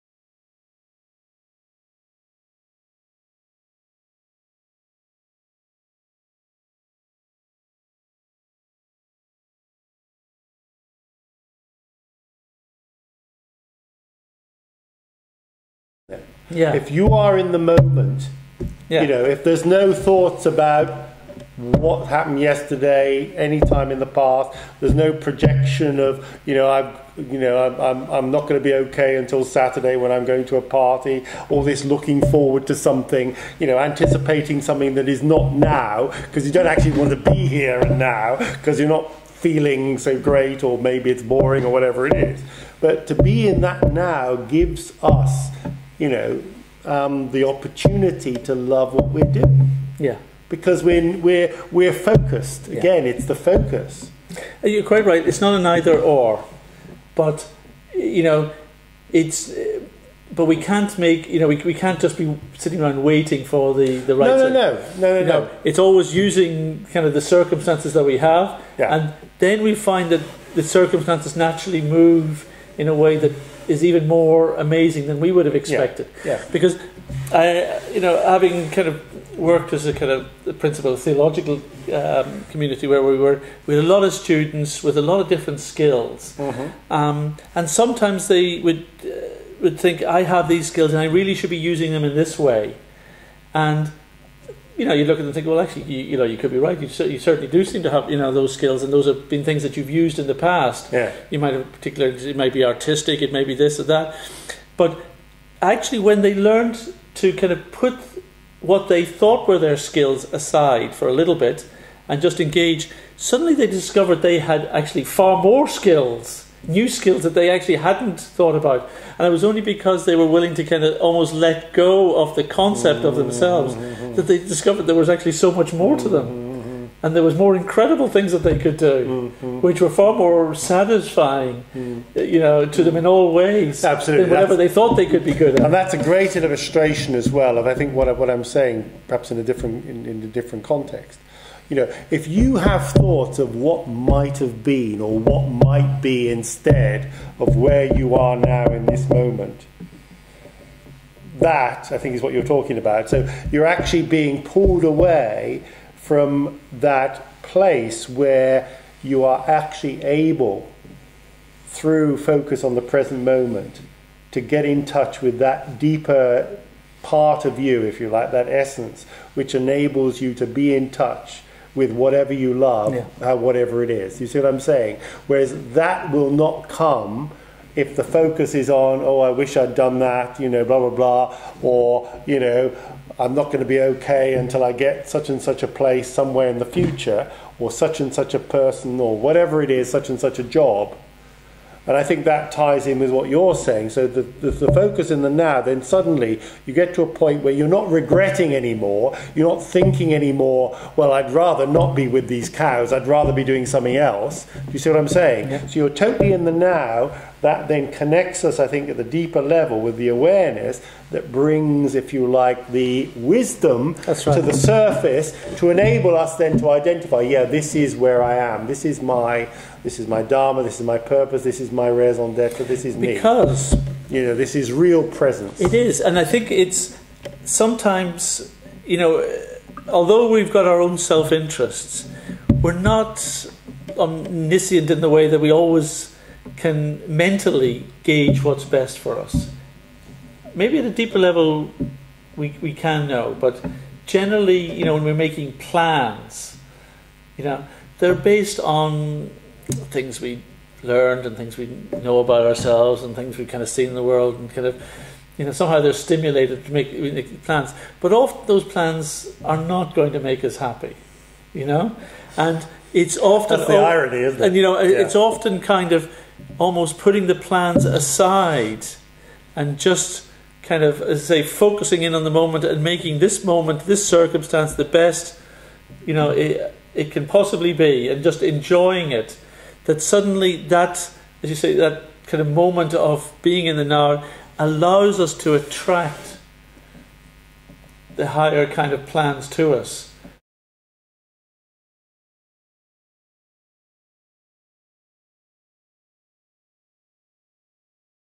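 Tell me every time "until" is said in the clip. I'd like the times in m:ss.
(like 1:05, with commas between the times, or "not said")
0:29, 3:04.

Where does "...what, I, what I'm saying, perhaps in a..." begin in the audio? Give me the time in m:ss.
2:17.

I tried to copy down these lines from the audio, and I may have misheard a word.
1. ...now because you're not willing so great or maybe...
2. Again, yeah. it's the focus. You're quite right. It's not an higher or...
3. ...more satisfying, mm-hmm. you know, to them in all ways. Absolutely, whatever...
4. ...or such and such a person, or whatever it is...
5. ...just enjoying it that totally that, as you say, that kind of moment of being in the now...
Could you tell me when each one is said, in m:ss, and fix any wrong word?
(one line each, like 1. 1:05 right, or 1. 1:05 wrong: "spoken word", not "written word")
1. 0:37 wrong: "feeling", not "willing"
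2. 0:52 wrong: "either", not "higher"
3. 2:10 right
4. 3:07 right
5. 4:38 wrong: "suddenly", not "totally".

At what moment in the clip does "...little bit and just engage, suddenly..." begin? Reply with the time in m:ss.
1:51.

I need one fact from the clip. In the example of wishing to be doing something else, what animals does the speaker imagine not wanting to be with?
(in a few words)
Cows.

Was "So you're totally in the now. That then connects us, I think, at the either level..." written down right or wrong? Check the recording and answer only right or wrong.
wrong.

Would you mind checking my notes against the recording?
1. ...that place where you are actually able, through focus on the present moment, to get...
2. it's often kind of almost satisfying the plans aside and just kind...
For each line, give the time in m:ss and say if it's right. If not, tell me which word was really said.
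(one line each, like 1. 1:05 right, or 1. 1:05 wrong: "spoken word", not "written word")
1. 2:36 right
2. 4:24 wrong: "putting", not "satisfying".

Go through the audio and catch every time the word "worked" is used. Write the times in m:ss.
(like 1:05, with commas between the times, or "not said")
1:19.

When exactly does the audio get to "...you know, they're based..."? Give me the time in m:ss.
4:07.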